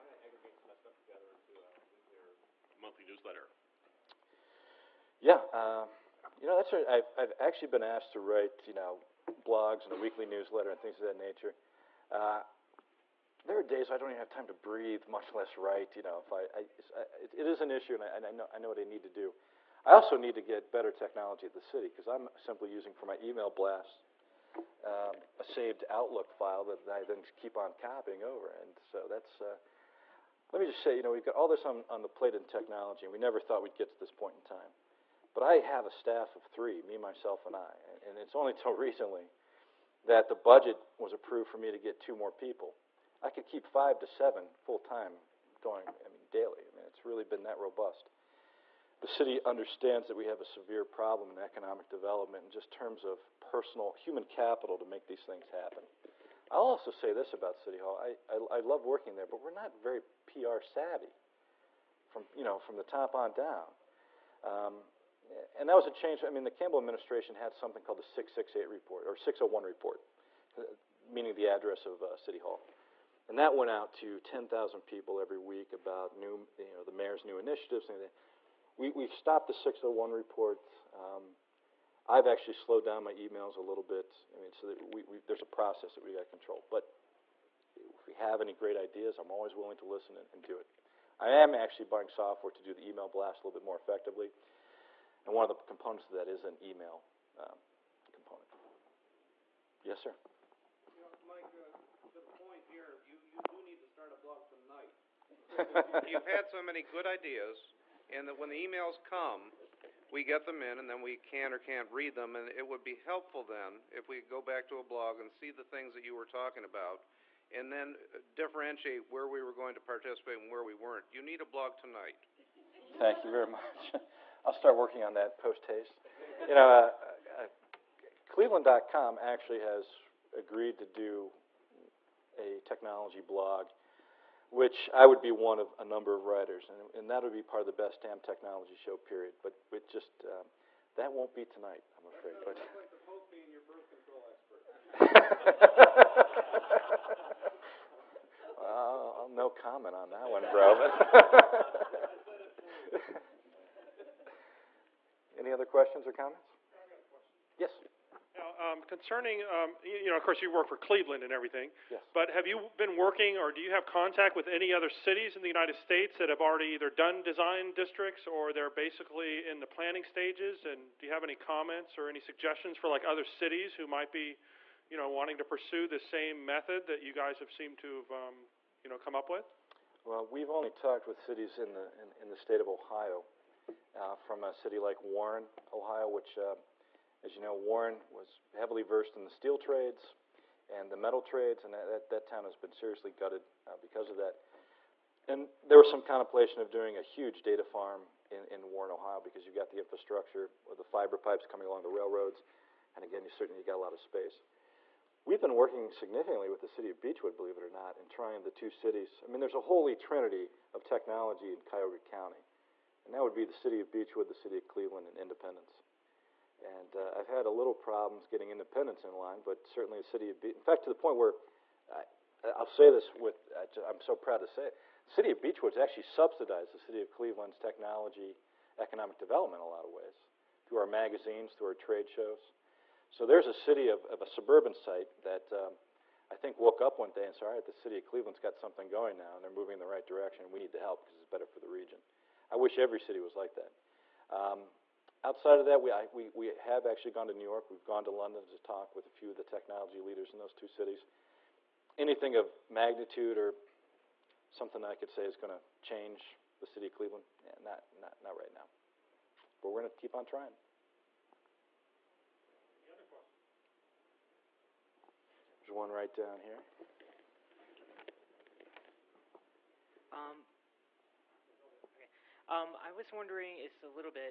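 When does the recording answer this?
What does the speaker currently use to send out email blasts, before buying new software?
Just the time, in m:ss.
0:25.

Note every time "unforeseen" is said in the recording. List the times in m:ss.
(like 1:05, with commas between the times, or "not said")
not said.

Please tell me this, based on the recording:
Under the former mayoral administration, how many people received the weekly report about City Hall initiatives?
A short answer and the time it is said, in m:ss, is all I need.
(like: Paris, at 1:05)
10,000, at 1:14.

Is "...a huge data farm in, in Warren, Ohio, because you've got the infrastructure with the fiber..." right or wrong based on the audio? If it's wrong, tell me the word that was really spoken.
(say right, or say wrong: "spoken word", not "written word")
right.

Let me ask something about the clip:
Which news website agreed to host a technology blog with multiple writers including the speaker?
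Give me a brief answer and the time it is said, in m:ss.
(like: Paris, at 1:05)
Cleveland.com, at 2:08.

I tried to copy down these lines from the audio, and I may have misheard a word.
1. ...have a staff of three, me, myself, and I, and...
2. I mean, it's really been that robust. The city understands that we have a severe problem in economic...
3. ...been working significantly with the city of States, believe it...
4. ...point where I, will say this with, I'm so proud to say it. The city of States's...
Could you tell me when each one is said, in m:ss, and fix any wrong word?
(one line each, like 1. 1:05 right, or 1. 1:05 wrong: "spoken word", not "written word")
1. 0:35 right
2. 0:46 right
3. 3:25 wrong: "Beachwood", not "States"
4. 3:40 wrong: "Beachwood", not "States".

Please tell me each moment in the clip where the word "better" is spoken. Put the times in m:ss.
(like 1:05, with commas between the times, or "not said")
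0:20, 4:01.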